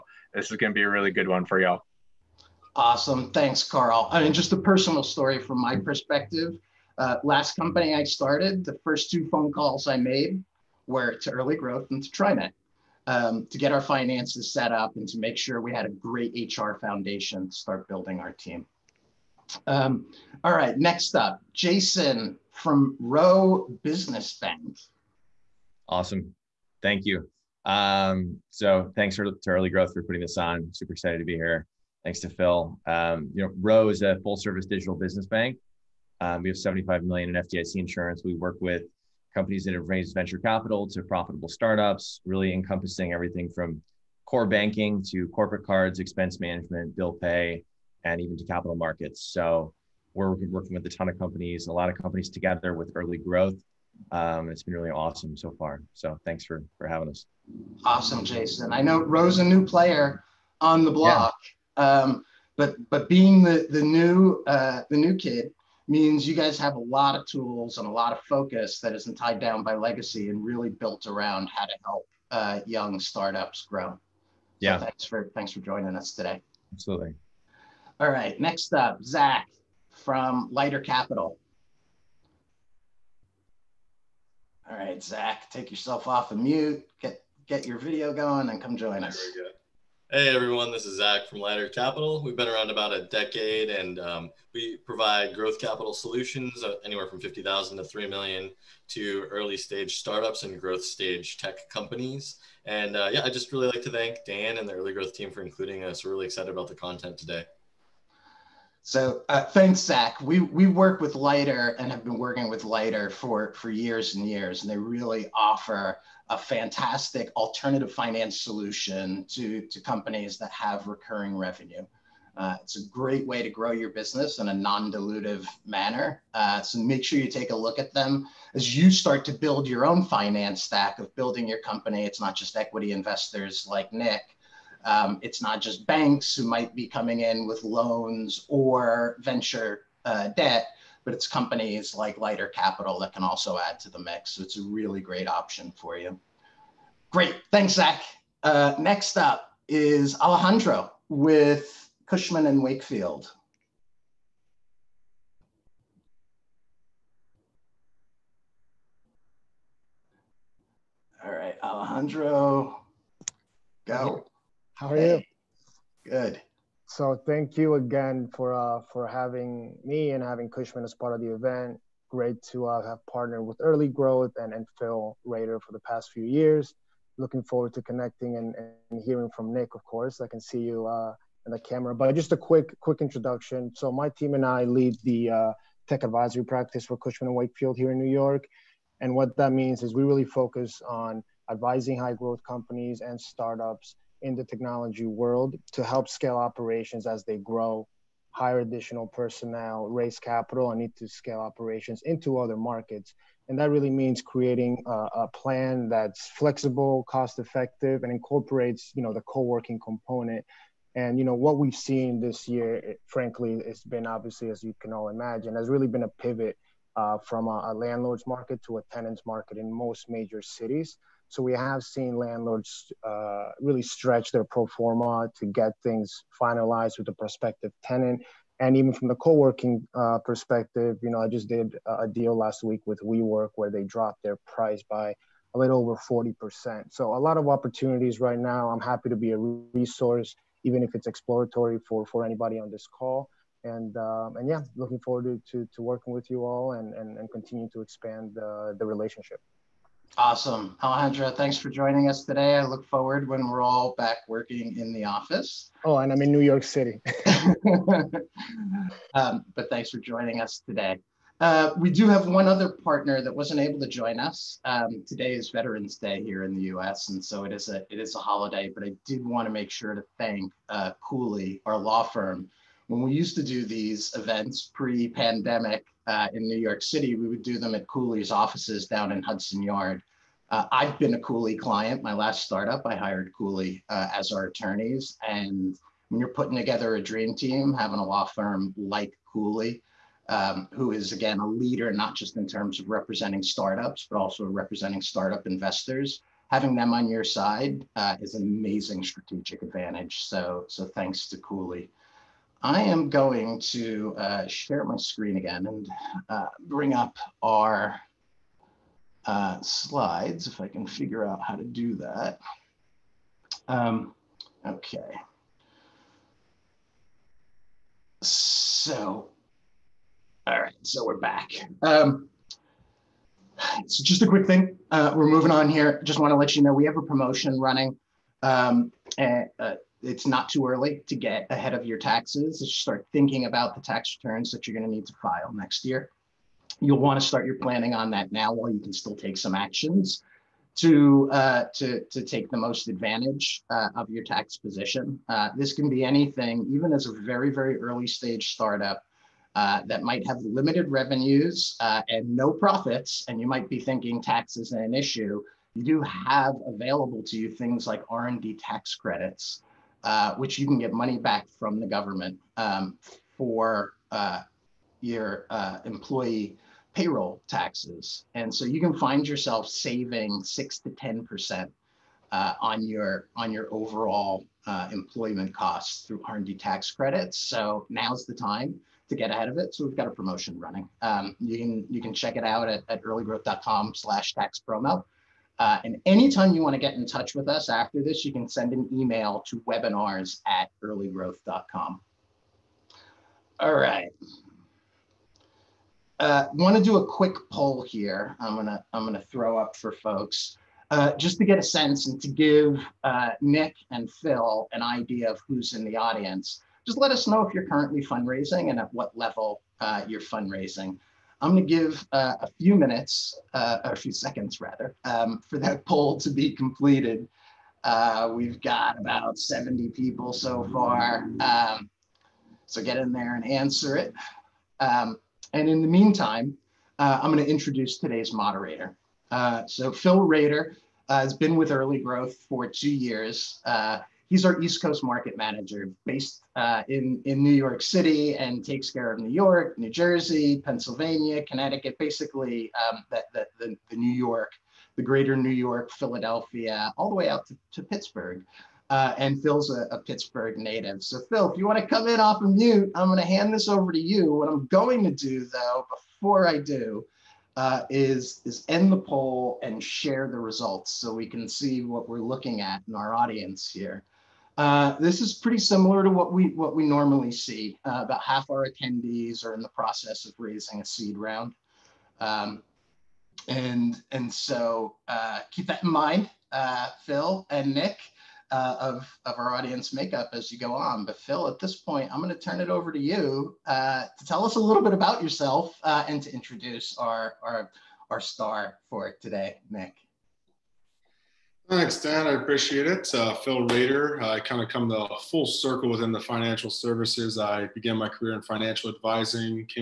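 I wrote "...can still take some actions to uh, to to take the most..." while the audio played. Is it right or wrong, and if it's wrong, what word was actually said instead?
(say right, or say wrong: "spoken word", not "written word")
right.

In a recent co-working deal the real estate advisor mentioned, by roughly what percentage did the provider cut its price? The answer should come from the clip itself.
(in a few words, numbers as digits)
40%.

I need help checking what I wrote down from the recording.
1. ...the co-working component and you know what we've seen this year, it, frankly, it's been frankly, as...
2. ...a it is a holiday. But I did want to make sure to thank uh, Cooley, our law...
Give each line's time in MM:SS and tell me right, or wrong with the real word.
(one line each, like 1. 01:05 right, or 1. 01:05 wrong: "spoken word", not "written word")
1. 03:29 wrong: "obviously", not "frankly"
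2. 04:27 right.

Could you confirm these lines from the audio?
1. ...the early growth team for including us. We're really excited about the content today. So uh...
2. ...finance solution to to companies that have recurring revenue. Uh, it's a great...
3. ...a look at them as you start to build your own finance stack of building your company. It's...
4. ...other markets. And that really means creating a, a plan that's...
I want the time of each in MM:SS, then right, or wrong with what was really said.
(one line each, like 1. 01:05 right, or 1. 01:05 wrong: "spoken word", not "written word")
1. 01:44 right
2. 01:57 right
3. 02:07 right
4. 03:22 right.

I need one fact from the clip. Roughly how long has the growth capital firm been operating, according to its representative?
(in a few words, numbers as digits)
About a decade.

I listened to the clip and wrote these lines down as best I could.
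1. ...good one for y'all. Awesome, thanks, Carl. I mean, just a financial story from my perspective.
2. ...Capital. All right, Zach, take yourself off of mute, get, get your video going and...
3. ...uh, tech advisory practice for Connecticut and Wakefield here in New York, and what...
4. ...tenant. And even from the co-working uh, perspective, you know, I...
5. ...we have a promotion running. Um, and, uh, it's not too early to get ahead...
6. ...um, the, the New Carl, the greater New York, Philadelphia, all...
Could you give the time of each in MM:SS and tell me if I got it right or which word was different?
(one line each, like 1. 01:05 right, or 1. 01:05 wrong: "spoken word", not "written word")
1. 00:01 wrong: "personal", not "financial"
2. 01:20 right
3. 03:05 wrong: "Cushman", not "Connecticut"
4. 03:47 right
5. 05:26 right
6. 07:22 wrong: "York", not "Carl".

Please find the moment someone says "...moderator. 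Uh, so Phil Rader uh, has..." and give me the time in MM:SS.
07:08.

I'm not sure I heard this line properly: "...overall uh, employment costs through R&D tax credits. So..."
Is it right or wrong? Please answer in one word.
right.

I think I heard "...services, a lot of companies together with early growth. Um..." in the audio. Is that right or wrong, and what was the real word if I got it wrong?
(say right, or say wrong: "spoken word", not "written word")
wrong: "companies", not "services".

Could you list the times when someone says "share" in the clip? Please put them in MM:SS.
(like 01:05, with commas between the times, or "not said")
05:04, 07:39.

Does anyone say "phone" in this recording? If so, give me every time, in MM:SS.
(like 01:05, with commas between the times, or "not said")
00:09.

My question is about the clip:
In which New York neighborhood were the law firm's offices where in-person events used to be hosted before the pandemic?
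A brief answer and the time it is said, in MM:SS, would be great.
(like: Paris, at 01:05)
Hudson Yard, at 04:39.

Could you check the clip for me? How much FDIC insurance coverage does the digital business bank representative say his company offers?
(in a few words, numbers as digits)
75 million.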